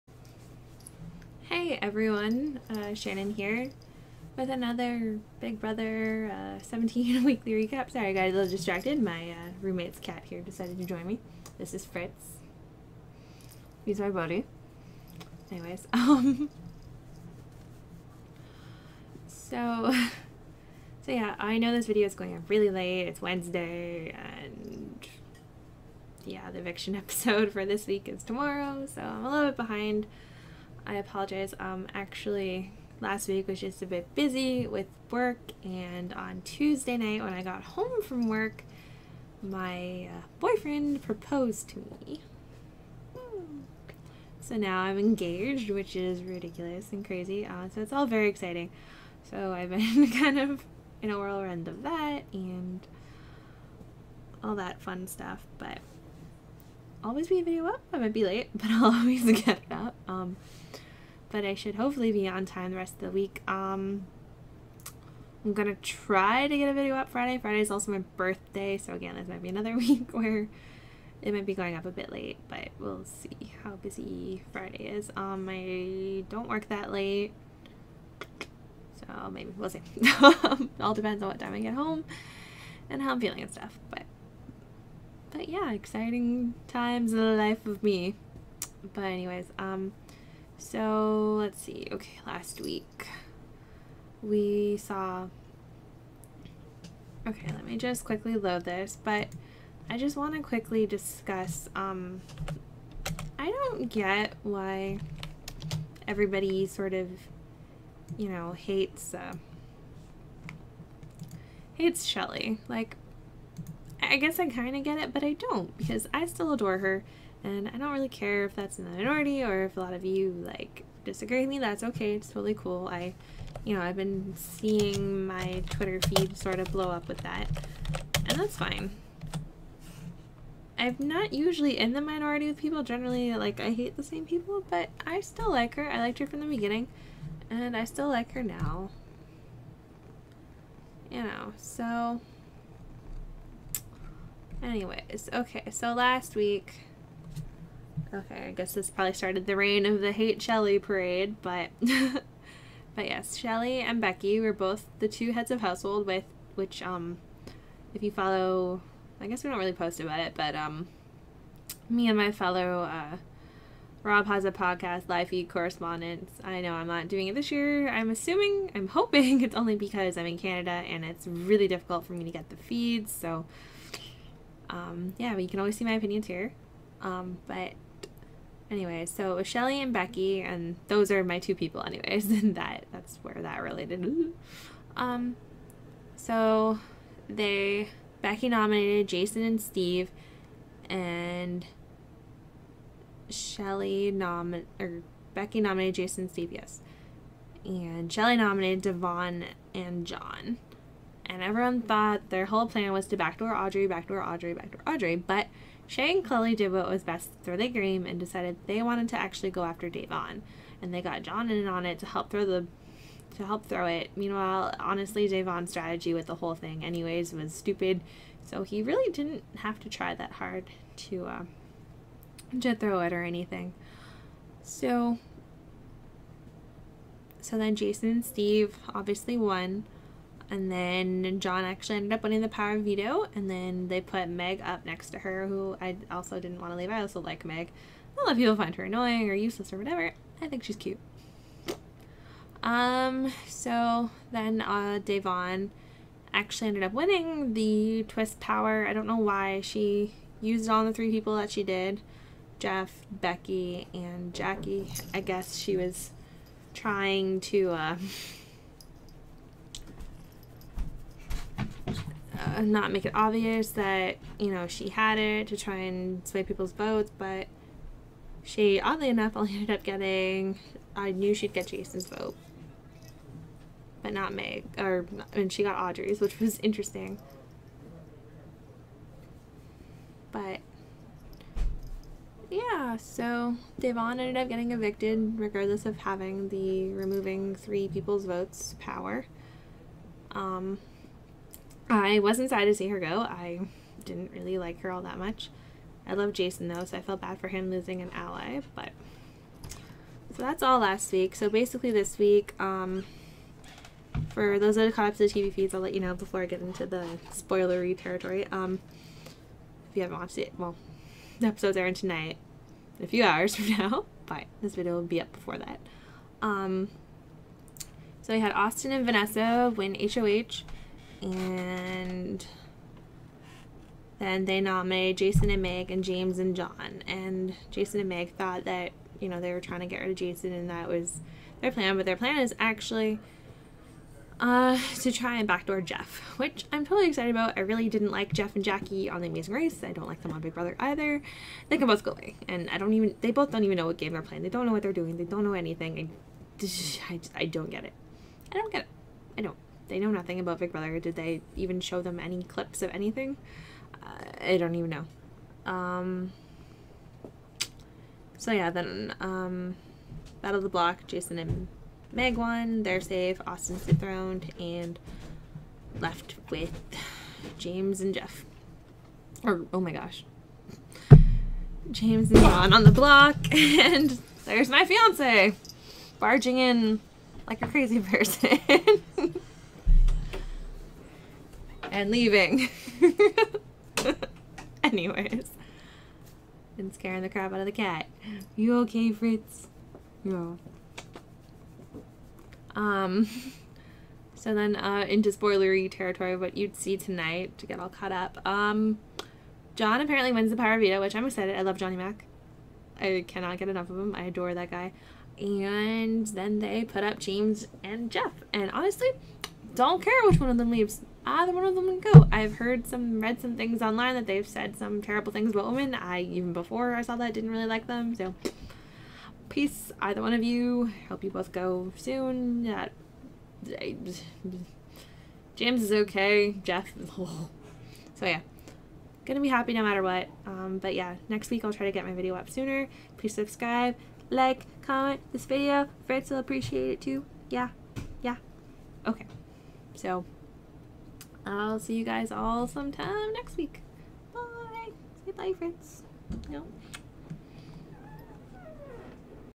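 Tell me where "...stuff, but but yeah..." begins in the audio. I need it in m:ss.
1:23.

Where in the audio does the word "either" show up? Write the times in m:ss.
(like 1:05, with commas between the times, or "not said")
5:40, 6:51, 7:00.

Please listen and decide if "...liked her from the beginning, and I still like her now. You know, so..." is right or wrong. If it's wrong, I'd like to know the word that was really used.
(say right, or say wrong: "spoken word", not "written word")
right.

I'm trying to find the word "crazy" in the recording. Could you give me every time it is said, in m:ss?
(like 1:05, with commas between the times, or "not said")
0:47, 6:17.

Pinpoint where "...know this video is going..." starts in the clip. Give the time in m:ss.
0:21.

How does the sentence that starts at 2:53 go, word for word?
So, um, yeah, but you can always see my opinions here.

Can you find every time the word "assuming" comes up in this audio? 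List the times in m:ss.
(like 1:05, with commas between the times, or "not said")
2:48.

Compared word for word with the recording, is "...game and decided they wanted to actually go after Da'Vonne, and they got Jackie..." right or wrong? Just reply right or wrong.
wrong.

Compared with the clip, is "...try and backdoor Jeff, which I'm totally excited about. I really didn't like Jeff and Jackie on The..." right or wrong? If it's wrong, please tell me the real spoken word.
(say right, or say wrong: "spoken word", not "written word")
right.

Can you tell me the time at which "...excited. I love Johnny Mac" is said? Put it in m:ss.
6:41.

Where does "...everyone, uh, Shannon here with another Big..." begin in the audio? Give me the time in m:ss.
0:01.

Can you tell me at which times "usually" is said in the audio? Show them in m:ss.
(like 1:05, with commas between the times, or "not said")
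2:11.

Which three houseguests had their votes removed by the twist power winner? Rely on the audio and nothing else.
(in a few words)
Jeff, Becky, and Jackie.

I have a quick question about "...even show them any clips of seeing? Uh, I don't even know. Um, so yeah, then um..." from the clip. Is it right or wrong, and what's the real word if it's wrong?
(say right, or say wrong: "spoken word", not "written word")
wrong: "anything", not "seeing".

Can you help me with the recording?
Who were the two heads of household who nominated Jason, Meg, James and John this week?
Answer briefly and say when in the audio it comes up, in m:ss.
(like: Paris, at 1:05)
Austin and Vanessa, at 5:18.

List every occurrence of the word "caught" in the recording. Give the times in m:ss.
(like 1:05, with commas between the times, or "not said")
5:04, 6:37.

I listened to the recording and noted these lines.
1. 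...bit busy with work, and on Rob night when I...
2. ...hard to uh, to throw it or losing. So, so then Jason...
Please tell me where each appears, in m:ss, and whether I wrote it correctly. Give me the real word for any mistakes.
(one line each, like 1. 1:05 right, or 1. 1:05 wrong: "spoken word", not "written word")
1. 0:33 wrong: "Tuesday", not "Rob"
2. 3:40 wrong: "anything", not "losing".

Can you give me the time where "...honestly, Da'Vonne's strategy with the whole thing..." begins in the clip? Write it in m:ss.
3:34.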